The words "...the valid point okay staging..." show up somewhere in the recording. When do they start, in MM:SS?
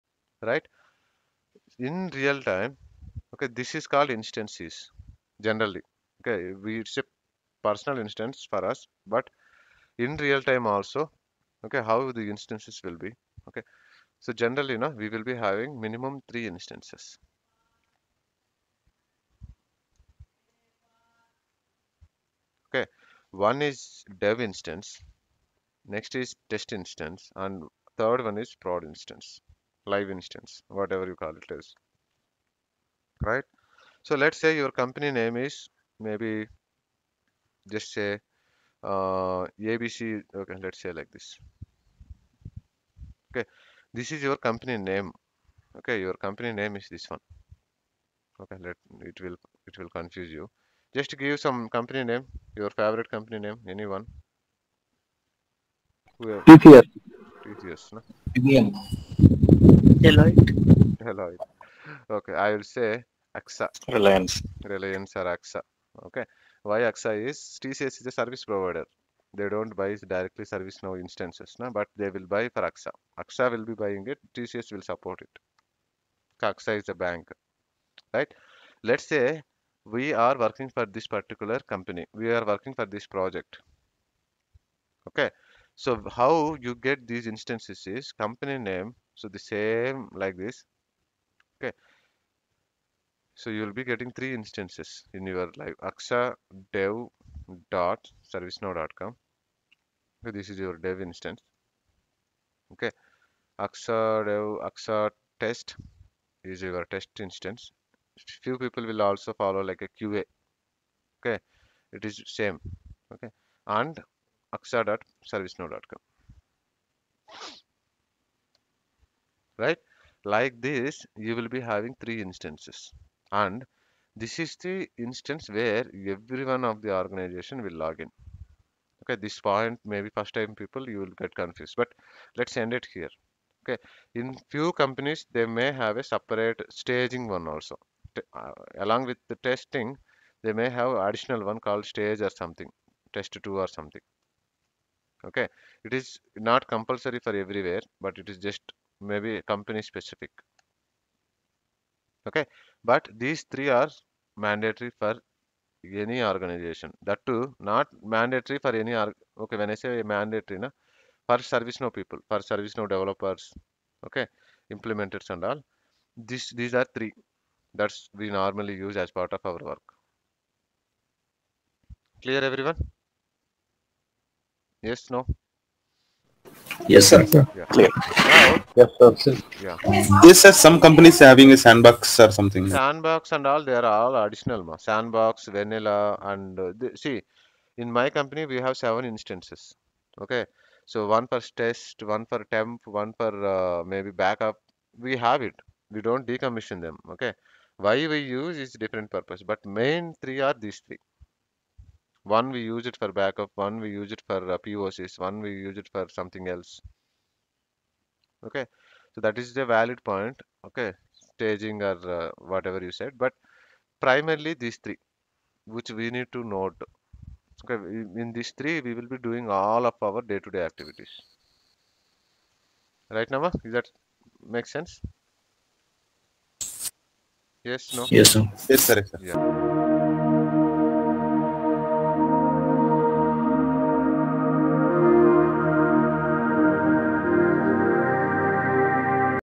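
03:29.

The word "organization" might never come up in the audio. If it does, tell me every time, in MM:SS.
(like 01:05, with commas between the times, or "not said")
02:07, 02:36.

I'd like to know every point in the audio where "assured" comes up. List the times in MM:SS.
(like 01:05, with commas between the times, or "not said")
not said.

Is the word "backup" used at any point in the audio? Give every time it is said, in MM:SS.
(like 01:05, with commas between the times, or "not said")
03:14, 03:23.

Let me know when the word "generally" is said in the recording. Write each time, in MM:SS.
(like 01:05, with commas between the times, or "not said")
00:05, 00:14.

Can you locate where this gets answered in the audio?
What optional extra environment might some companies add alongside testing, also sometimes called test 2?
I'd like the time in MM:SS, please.
02:21.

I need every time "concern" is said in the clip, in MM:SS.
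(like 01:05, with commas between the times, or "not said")
not said.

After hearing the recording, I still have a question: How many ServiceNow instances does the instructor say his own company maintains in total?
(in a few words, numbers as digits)
7.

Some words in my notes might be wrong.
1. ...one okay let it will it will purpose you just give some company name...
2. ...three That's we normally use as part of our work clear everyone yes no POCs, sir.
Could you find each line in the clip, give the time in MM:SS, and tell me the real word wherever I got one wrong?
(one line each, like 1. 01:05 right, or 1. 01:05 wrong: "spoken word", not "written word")
1. 00:47 wrong: "confuse", not "purpose"
2. 02:46 wrong: "Yes", not "POCs".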